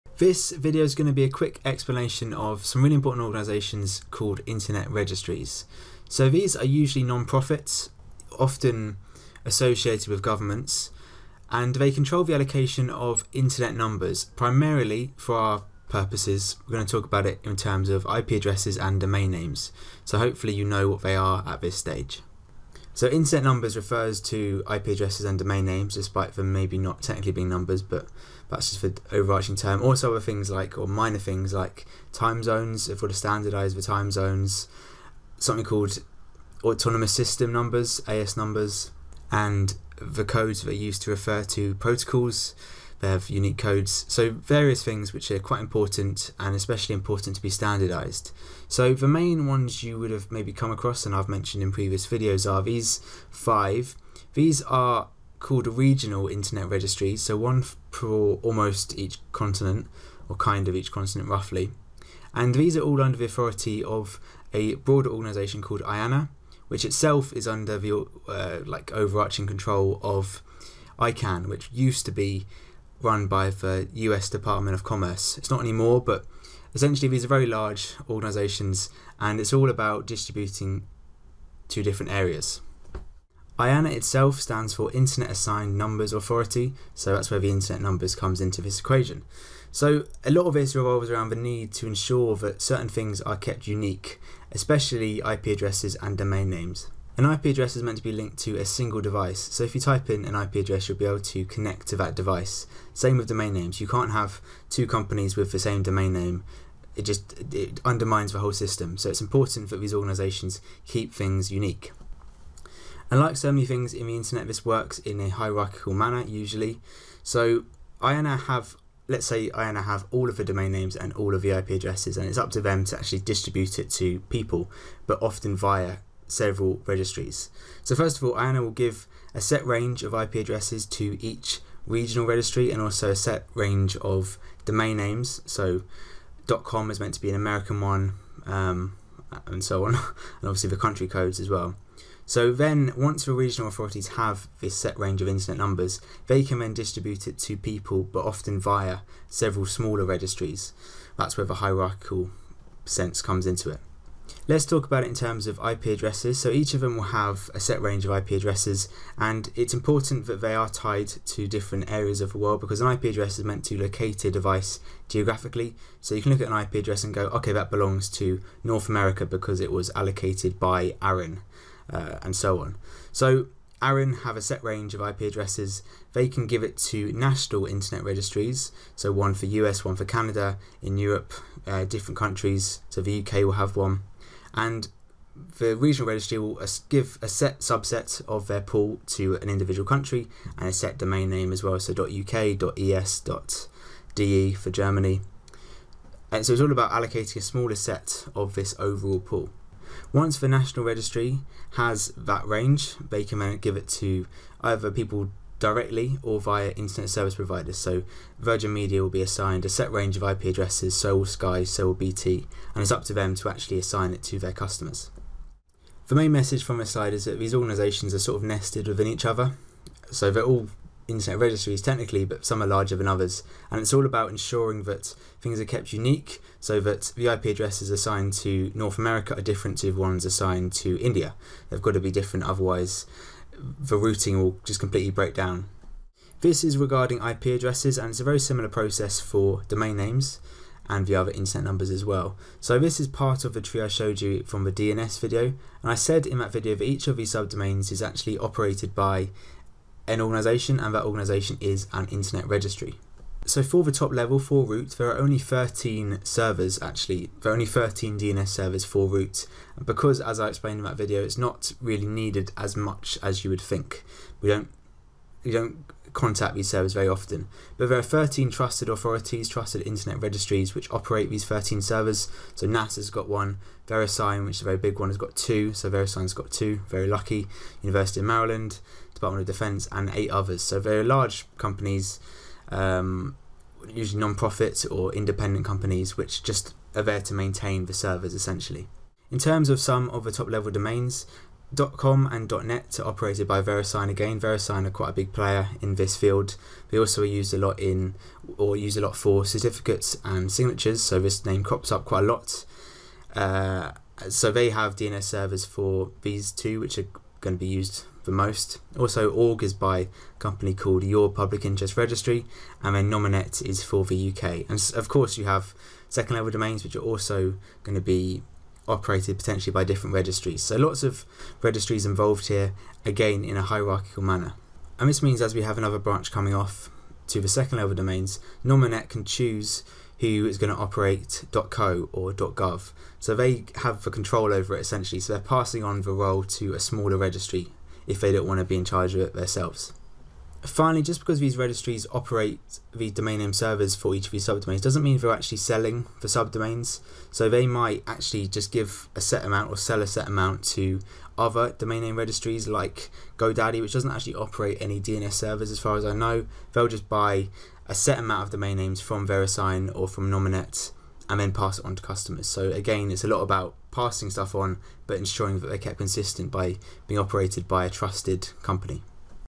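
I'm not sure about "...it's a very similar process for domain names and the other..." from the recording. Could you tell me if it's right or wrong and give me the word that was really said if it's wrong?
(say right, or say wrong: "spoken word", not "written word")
right.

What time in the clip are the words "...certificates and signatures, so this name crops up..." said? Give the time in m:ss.
4:59.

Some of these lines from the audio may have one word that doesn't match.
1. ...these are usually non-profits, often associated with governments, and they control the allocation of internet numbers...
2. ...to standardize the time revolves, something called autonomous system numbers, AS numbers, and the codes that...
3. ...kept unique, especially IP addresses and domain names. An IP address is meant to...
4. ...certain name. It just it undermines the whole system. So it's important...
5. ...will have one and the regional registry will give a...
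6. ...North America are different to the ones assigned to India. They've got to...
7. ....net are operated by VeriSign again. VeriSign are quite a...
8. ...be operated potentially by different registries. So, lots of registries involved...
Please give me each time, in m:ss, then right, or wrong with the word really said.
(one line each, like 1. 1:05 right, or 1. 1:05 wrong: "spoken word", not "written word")
1. 0:06 right
2. 0:33 wrong: "zones", not "revolves"
3. 1:33 right
4. 1:45 wrong: "domain", not "certain"
5. 3:03 right
6. 3:48 right
7. 4:52 right
8. 5:18 right.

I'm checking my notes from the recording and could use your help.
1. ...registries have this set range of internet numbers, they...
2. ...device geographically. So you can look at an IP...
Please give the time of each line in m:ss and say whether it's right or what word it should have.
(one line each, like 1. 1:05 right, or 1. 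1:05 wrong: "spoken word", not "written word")
1. 2:23 wrong: "authorities", not "registries"
2. 2:44 right.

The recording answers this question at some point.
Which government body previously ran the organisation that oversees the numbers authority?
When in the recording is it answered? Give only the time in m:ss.
1:13.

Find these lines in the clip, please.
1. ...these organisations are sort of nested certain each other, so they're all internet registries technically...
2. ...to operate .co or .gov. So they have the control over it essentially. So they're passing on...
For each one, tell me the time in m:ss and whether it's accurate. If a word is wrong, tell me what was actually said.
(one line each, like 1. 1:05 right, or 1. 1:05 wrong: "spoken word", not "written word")
1. 3:37 wrong: "within", not "certain"
2. 5:30 right.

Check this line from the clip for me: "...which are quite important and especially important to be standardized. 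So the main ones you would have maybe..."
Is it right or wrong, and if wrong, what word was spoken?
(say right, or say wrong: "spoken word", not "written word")
right.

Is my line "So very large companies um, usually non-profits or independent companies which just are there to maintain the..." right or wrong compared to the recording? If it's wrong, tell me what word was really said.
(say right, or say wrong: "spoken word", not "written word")
right.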